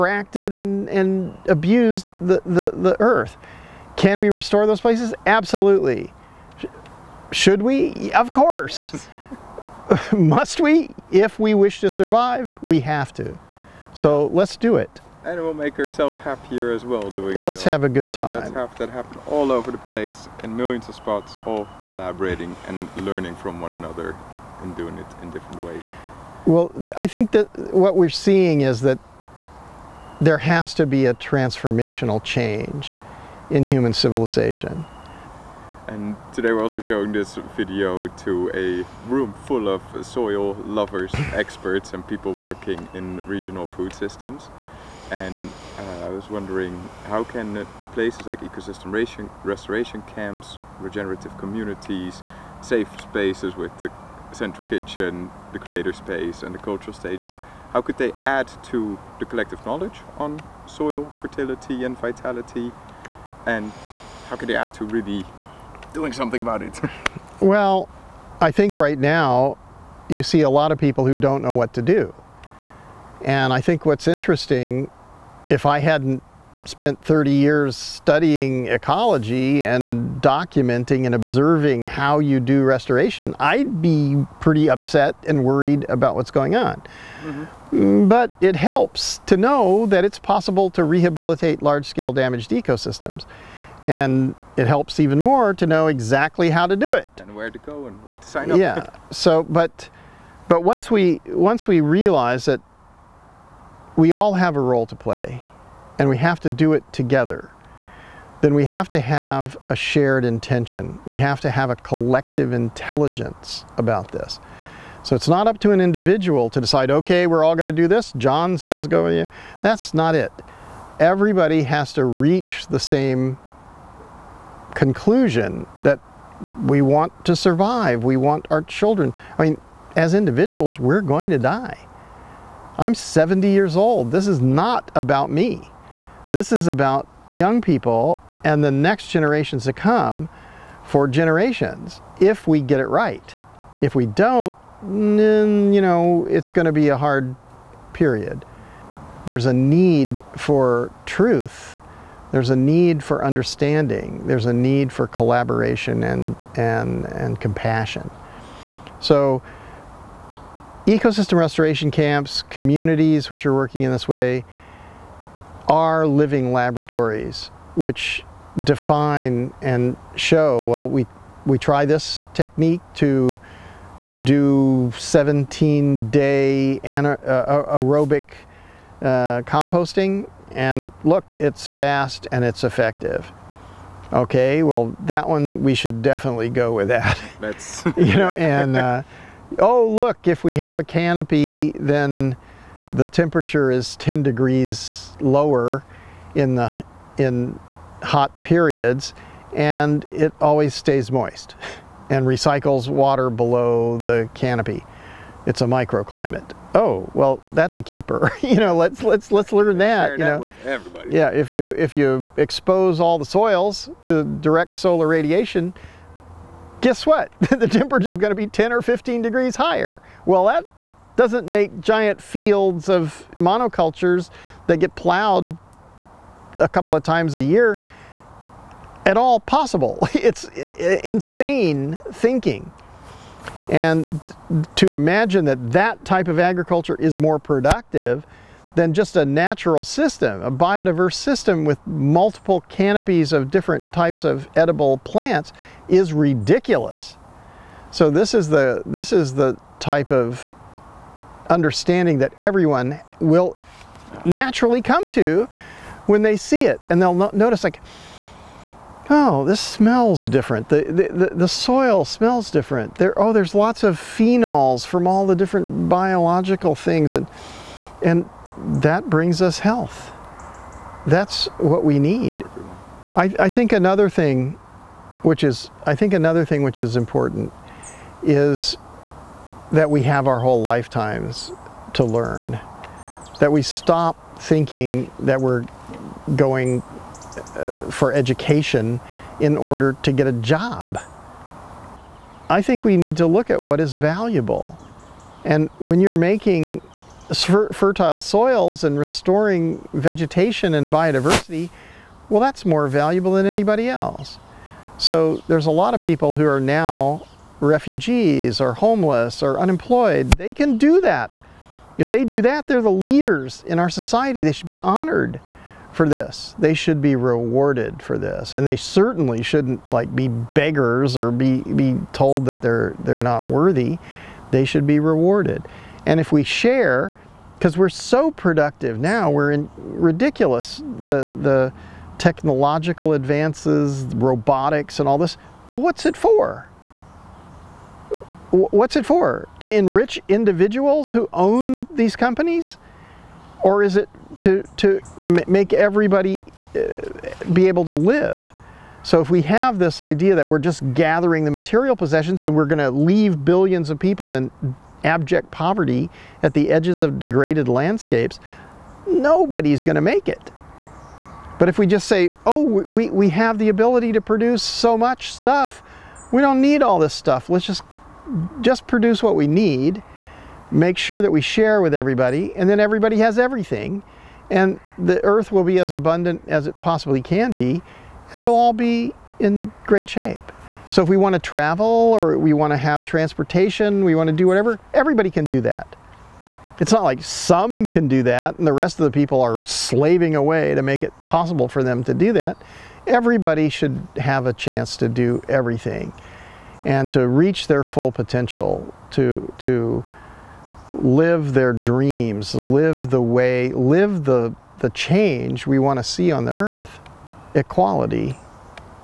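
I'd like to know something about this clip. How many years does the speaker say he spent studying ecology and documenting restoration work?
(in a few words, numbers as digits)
30.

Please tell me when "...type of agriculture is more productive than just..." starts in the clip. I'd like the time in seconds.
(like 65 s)
236 s.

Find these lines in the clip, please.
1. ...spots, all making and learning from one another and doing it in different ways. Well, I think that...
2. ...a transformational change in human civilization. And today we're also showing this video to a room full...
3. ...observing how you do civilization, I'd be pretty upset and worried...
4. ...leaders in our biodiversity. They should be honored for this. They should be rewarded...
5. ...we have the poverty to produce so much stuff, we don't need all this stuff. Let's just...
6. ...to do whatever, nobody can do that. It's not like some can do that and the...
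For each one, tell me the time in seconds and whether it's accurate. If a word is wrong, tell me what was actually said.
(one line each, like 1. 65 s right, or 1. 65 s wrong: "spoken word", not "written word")
1. 20 s wrong: "collaborating", not "making"
2. 31 s right
3. 81 s wrong: "restoration", not "civilization"
4. 312 s wrong: "society", not "biodiversity"
5. 363 s wrong: "ability", not "poverty"
6. 384 s wrong: "everybody", not "nobody".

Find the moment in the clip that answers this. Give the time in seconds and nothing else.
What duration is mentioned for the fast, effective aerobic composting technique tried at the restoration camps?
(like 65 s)
174 s.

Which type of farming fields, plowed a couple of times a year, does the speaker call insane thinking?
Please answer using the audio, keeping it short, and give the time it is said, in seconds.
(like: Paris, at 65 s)
Monocultures, at 223 s.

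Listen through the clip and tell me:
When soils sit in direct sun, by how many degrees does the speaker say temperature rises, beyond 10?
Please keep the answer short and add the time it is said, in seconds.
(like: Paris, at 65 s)
15, at 218 s.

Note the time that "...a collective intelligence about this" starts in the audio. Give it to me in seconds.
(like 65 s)
111 s.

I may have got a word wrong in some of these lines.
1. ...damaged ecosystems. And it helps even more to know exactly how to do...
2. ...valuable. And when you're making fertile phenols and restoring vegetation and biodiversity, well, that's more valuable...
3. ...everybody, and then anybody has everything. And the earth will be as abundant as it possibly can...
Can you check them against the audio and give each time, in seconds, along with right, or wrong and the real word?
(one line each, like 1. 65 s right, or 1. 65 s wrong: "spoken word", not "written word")
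1. 92 s right
2. 293 s wrong: "soils", not "phenols"
3. 371 s wrong: "everybody", not "anybody".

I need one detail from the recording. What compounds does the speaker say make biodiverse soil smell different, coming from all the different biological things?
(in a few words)
Phenols.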